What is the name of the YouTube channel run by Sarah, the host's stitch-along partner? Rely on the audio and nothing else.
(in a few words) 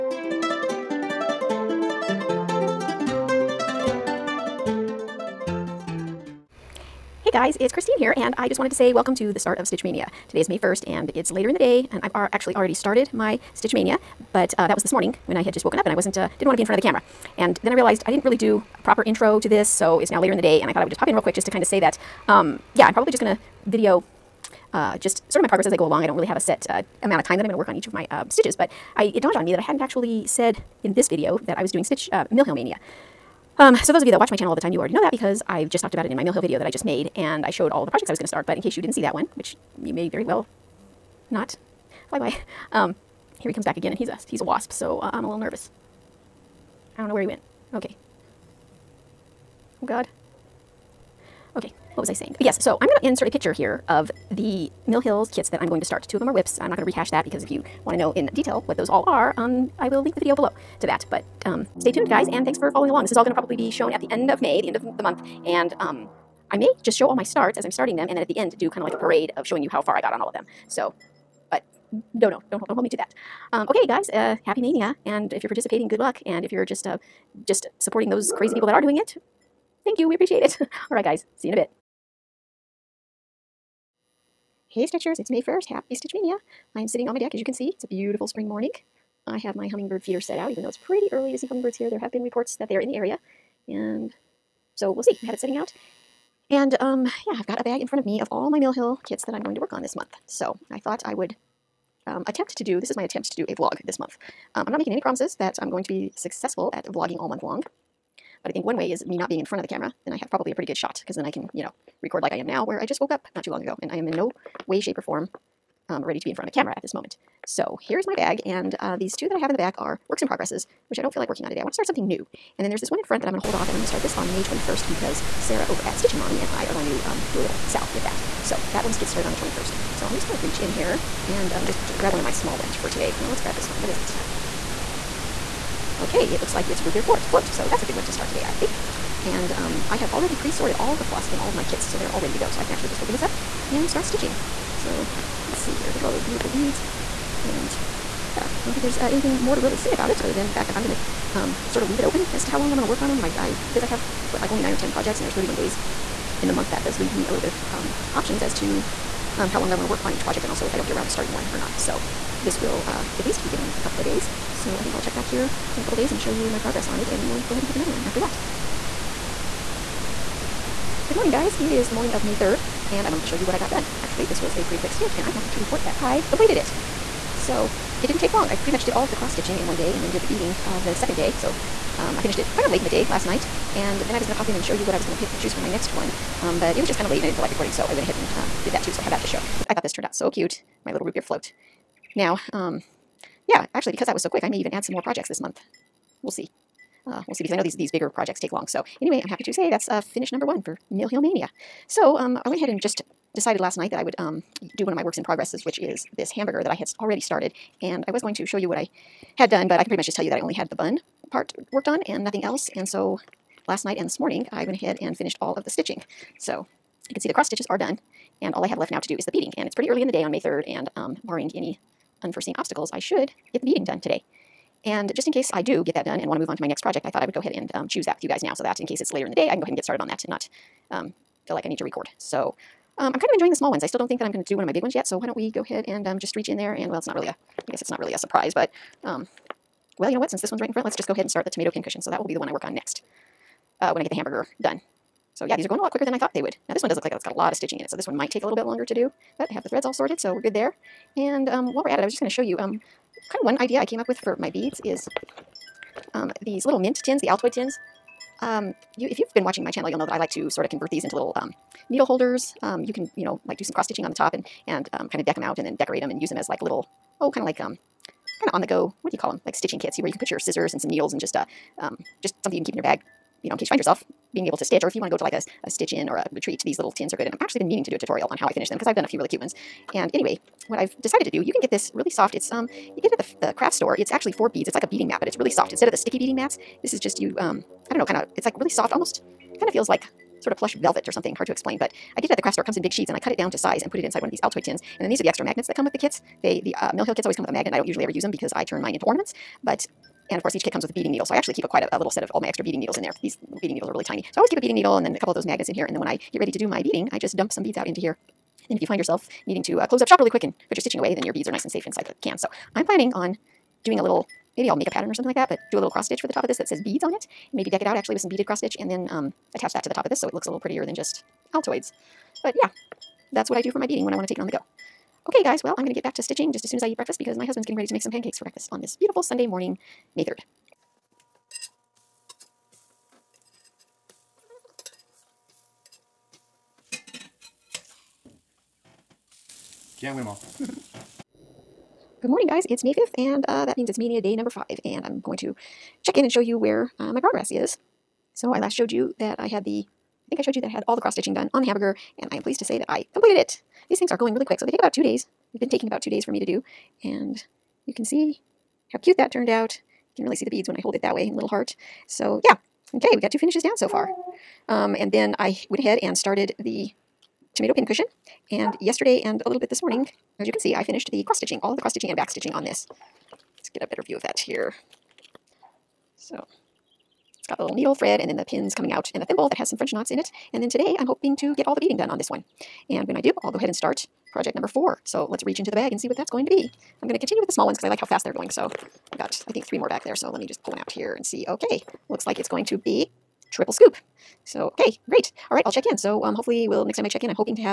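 Stitchin' Mommy.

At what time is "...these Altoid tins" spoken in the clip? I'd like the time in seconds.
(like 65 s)
294 s.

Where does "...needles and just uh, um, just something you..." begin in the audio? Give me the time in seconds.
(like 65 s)
270 s.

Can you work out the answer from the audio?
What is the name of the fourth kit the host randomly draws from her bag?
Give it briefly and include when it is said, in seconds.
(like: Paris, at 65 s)
triple scoop, at 393 s.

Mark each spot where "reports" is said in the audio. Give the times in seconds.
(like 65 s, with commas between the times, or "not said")
92 s, 175 s.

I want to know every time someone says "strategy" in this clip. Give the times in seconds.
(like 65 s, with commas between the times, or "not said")
not said.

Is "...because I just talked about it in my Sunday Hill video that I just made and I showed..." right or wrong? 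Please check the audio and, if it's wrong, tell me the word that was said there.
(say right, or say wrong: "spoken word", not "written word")
wrong: "Mill", not "Sunday".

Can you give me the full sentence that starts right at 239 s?
Um, well, you know what, since this one's right in front, let's just go ahead and start the tomato pincushion.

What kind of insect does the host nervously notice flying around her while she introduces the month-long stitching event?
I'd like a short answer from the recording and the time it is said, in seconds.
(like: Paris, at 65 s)
wasp, at 44 s.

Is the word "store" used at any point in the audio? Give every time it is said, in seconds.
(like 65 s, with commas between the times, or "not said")
283 s, 292 s.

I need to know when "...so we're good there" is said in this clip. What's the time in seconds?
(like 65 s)
250 s.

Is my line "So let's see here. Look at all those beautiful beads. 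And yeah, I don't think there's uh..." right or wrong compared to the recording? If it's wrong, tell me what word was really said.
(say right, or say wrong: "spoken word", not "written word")
right.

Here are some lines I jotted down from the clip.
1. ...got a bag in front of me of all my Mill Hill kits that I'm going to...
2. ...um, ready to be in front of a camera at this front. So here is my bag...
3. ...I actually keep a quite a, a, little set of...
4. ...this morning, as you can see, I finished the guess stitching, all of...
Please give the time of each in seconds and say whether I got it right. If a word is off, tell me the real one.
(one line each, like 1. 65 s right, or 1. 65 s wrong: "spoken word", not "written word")
1. 97 s right
2. 115 s wrong: "moment", not "front"
3. 301 s right
4. 369 s wrong: "cross", not "guess".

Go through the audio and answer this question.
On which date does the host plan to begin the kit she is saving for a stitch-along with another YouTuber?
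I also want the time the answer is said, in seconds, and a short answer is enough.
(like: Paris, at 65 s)
May 21st, at 124 s.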